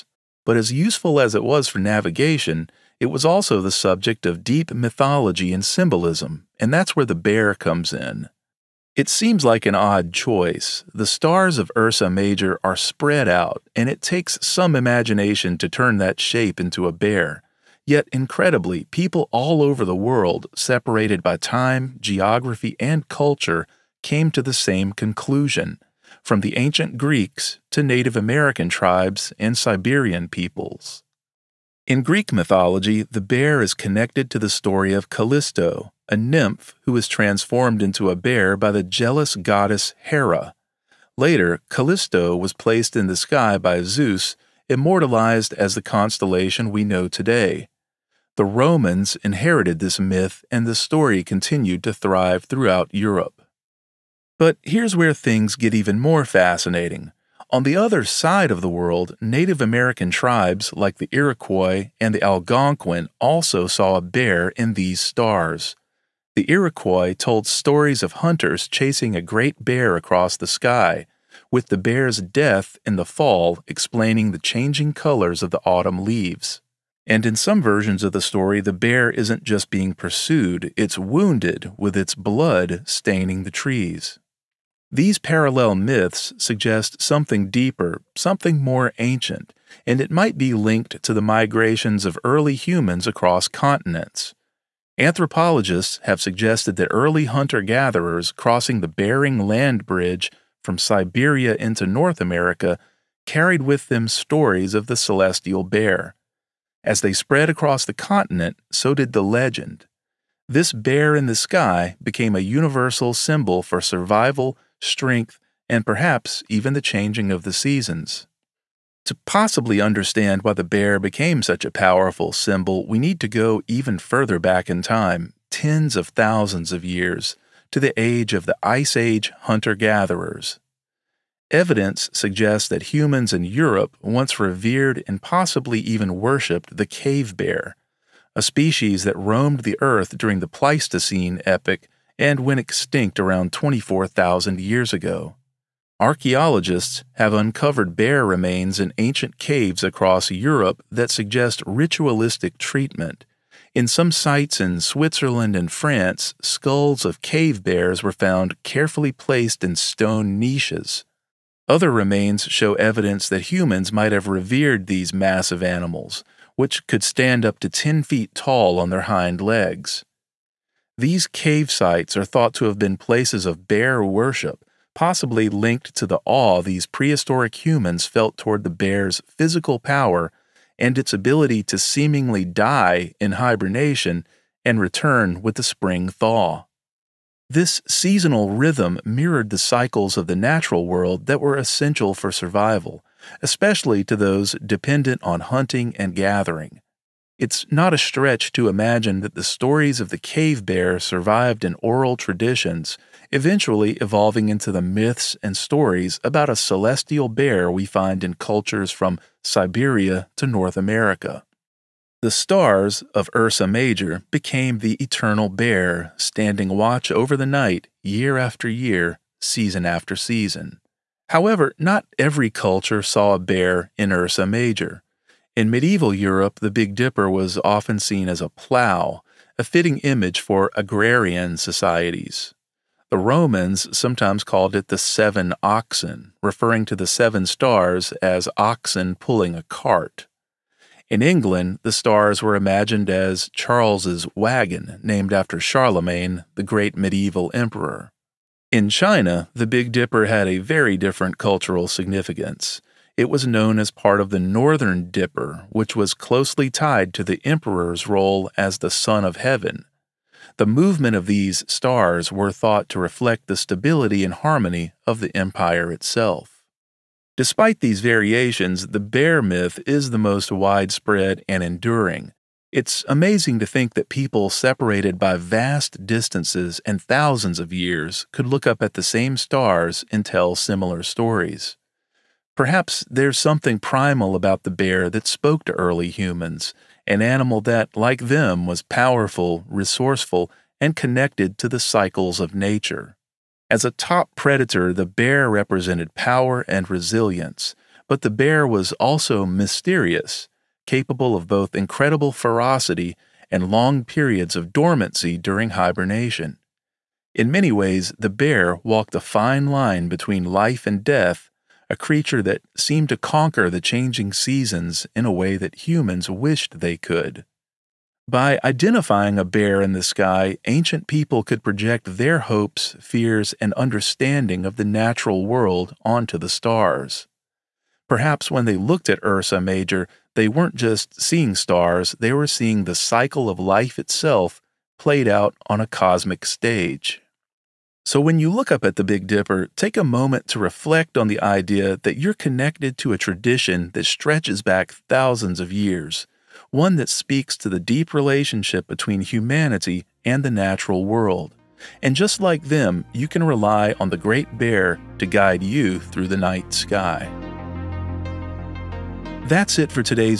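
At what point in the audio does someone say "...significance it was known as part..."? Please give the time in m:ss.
4:11.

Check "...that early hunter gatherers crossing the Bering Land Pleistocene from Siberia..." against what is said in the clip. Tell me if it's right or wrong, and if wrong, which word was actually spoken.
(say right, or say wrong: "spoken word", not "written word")
wrong: "Bridge", not "Pleistocene".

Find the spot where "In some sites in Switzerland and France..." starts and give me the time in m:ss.
2:33.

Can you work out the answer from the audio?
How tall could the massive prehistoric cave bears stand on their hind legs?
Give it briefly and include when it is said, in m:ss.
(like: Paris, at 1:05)
10 feet, at 2:47.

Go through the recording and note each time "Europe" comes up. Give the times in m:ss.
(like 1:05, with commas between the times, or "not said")
0:52, 2:13, 2:30, 3:46.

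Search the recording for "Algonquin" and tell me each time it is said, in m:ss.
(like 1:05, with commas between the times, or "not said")
1:02.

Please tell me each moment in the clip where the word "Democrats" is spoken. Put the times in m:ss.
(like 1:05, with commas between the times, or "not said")
not said.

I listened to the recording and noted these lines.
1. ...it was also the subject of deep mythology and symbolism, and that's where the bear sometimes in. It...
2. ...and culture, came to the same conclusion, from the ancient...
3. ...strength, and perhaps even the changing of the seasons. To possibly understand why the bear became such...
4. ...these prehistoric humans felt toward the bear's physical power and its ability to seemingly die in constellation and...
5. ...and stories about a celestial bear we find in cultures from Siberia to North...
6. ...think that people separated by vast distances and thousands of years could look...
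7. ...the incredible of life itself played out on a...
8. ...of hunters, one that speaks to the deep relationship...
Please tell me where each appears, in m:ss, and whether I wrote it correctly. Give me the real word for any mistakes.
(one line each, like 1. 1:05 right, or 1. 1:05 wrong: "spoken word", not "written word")
1. 0:03 wrong: "comes", not "sometimes"
2. 0:22 right
3. 1:54 right
4. 2:56 wrong: "hibernation", not "constellation"
5. 3:25 right
6. 4:33 right
7. 5:32 wrong: "cycle", not "incredible"
8. 5:45 wrong: "years", not "hunters".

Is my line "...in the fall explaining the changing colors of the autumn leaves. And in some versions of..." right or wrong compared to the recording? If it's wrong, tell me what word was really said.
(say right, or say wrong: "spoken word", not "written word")
right.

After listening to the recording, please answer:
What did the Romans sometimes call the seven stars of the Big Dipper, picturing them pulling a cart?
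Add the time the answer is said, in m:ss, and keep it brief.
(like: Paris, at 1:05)
the seven oxen, at 3:54.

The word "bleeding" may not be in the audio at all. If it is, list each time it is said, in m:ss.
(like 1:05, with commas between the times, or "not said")
not said.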